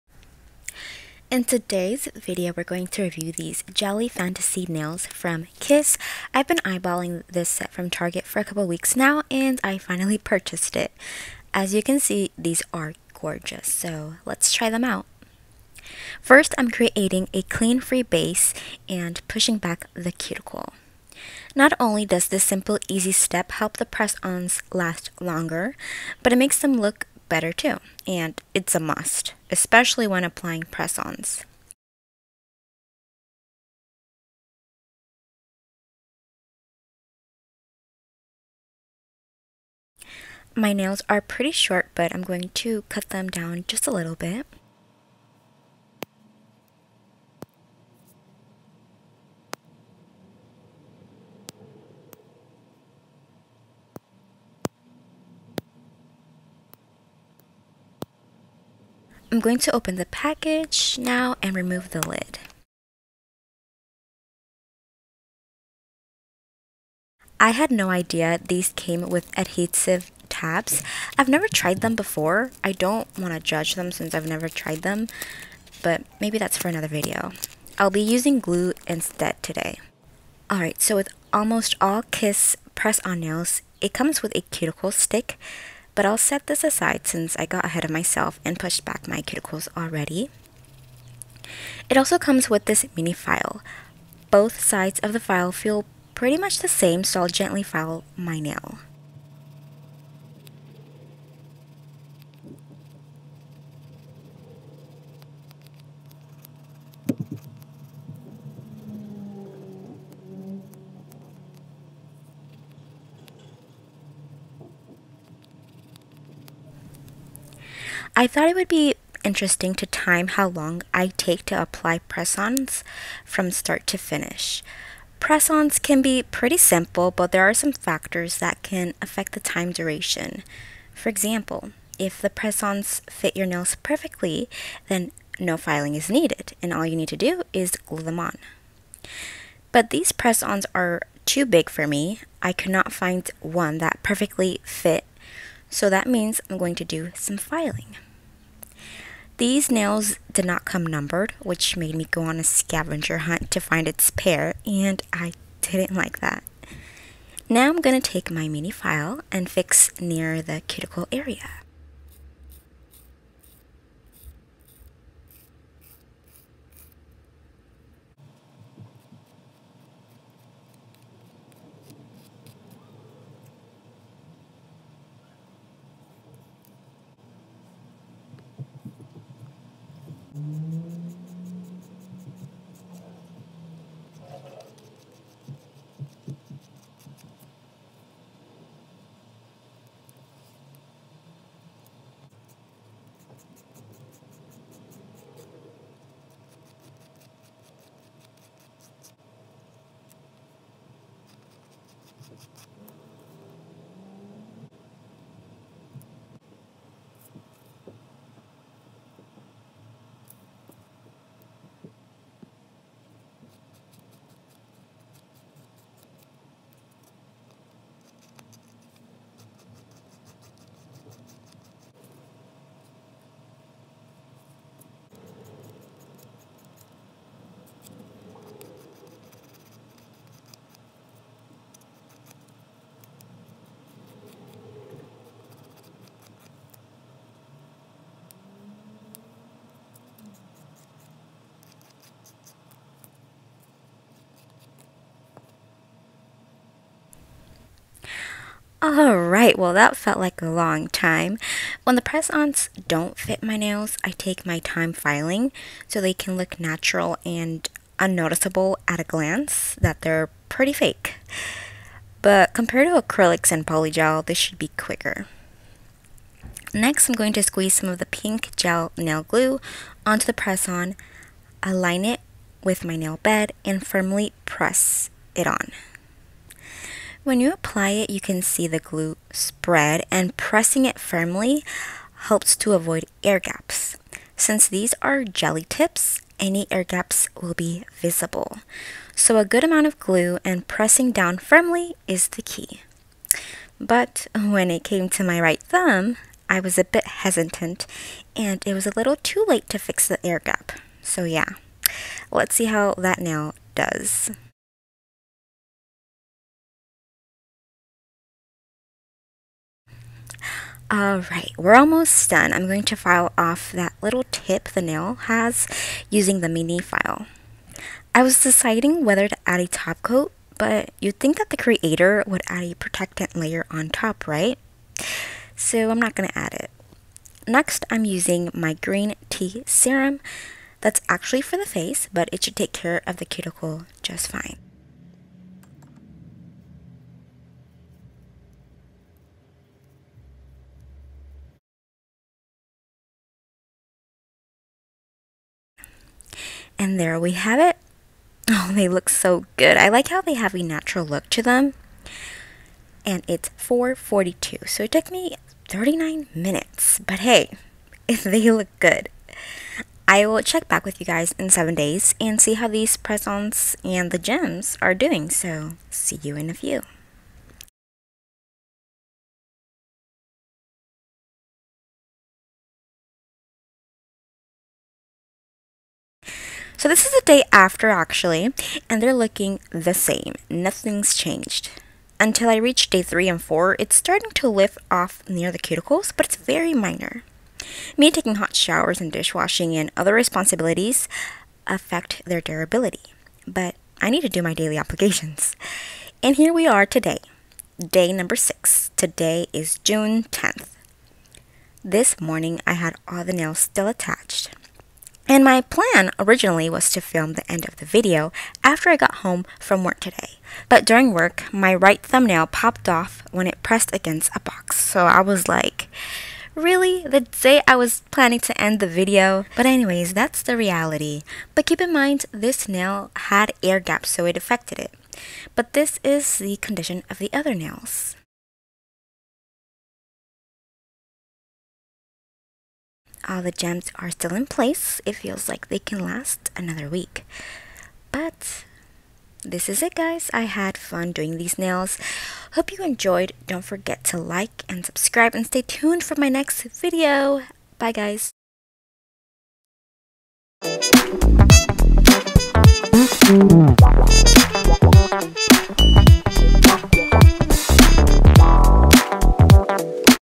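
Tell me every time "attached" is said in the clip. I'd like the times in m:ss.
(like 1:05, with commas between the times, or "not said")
6:43.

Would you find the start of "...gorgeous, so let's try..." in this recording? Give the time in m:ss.
0:13.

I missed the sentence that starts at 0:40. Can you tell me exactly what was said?
My nails are pretty short, but I'm going to cut them down just a little bit.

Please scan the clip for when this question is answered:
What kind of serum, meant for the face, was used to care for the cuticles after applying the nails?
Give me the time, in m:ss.
5:28.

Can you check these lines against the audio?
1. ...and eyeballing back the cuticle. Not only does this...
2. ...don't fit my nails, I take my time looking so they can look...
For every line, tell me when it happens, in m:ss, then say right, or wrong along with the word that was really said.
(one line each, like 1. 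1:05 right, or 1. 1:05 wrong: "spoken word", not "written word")
1. 0:18 wrong: "pushing", not "eyeballing"
2. 4:12 wrong: "filing", not "looking".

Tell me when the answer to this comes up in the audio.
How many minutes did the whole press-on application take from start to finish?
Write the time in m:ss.
5:55.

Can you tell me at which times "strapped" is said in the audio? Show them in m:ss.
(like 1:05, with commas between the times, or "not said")
not said.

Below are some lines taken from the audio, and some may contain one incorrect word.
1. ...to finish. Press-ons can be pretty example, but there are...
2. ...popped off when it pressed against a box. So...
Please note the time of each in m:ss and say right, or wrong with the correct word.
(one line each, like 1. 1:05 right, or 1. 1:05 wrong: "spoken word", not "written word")
1. 2:03 wrong: "simple", not "example"
2. 6:52 right.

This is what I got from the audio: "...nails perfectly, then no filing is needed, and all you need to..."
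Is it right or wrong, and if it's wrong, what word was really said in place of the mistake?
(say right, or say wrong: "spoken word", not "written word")
right.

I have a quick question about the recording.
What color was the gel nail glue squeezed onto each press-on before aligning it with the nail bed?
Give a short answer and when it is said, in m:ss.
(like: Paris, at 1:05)
pink, at 4:28.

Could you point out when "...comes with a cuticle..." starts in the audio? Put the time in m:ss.
1:23.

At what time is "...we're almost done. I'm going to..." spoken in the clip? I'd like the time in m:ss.
5:11.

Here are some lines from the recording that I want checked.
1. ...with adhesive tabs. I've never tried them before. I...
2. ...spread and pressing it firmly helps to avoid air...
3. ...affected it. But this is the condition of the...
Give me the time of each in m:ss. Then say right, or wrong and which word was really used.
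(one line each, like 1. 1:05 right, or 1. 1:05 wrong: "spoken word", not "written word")
1. 1:09 right
2. 4:39 right
3. 7:04 right.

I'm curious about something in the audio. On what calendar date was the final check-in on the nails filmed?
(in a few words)
June 10th.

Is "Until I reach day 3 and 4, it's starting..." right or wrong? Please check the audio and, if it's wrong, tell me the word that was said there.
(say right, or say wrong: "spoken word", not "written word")
right.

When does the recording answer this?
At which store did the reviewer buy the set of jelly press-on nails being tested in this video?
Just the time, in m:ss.
0:07.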